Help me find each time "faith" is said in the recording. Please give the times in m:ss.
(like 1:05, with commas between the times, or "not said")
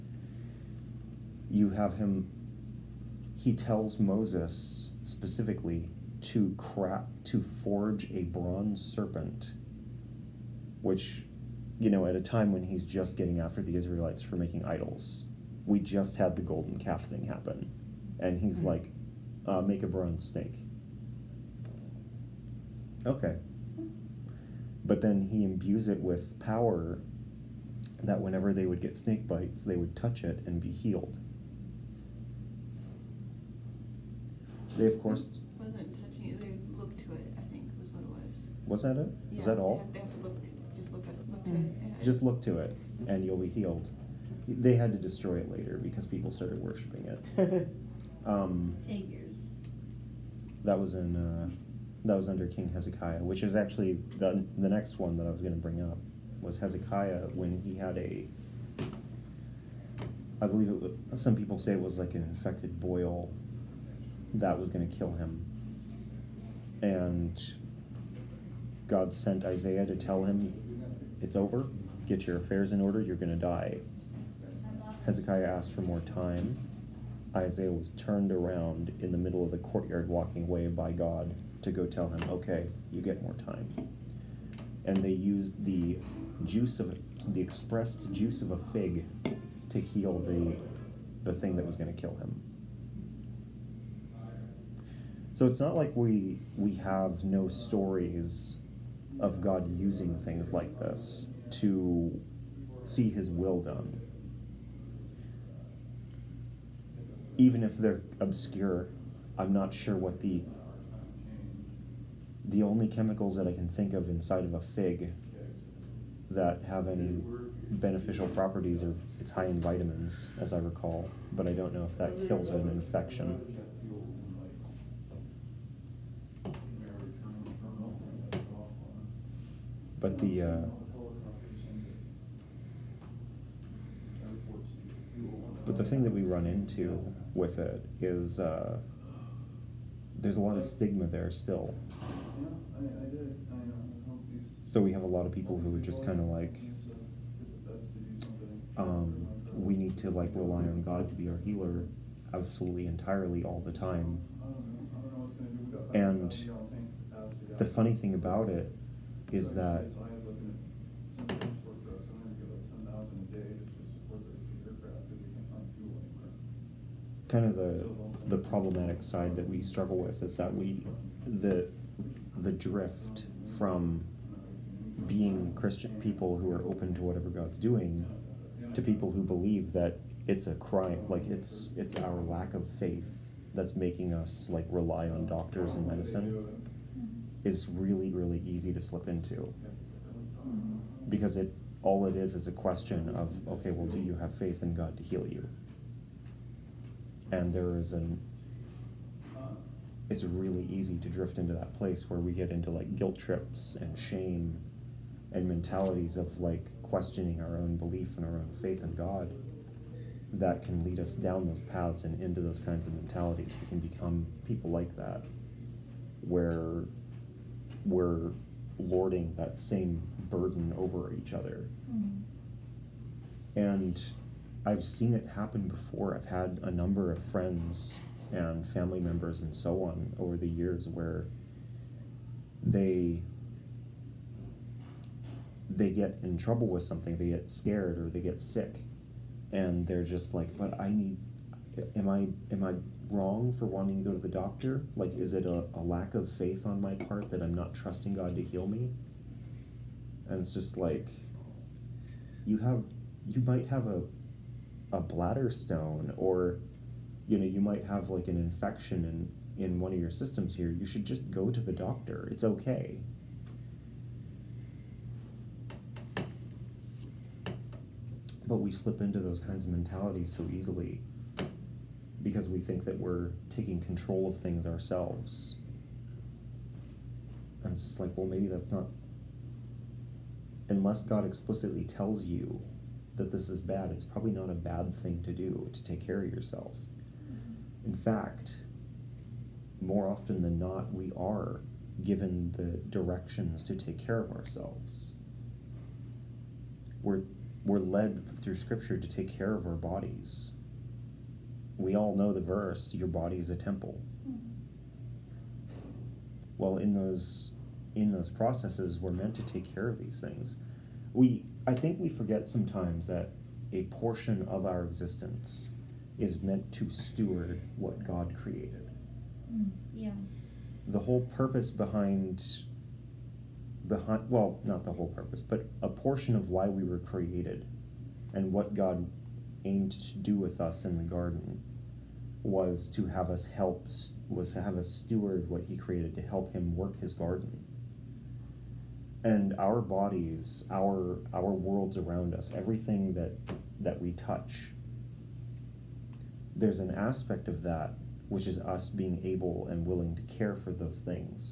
3:02, 3:14, 3:28, 4:06.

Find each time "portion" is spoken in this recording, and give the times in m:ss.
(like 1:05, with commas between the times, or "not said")
5:13, 5:25.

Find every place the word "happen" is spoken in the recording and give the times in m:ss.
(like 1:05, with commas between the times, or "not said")
0:17, 3:45.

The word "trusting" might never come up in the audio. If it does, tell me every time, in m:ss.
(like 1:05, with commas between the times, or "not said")
4:07.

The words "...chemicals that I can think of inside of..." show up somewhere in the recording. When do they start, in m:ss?
1:52.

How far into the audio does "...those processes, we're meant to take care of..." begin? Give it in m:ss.
5:08.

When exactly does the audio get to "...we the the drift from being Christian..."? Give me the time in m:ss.
2:50.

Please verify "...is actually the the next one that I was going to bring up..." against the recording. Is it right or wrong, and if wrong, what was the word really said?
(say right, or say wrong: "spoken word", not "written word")
right.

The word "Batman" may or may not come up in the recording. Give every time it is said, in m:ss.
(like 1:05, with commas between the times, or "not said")
not said.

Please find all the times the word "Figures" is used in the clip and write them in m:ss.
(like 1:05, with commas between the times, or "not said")
0:48.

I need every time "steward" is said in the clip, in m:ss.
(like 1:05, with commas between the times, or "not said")
5:16, 5:34.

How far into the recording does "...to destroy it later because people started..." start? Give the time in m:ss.
0:44.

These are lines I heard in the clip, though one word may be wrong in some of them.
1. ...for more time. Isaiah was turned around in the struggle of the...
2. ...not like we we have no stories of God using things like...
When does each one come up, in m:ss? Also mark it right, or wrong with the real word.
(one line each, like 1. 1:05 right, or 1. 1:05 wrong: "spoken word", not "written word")
1. 1:15 wrong: "middle", not "struggle"
2. 1:35 right.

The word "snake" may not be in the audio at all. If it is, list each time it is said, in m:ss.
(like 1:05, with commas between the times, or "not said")
0:20, 0:28.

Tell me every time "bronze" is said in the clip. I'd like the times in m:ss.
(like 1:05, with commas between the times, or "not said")
0:08, 0:19.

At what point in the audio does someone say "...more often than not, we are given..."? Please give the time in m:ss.
4:49.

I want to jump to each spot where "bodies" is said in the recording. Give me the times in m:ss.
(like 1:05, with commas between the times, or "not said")
4:59, 5:39.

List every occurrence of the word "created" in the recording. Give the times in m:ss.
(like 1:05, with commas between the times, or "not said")
5:18, 5:26, 5:35.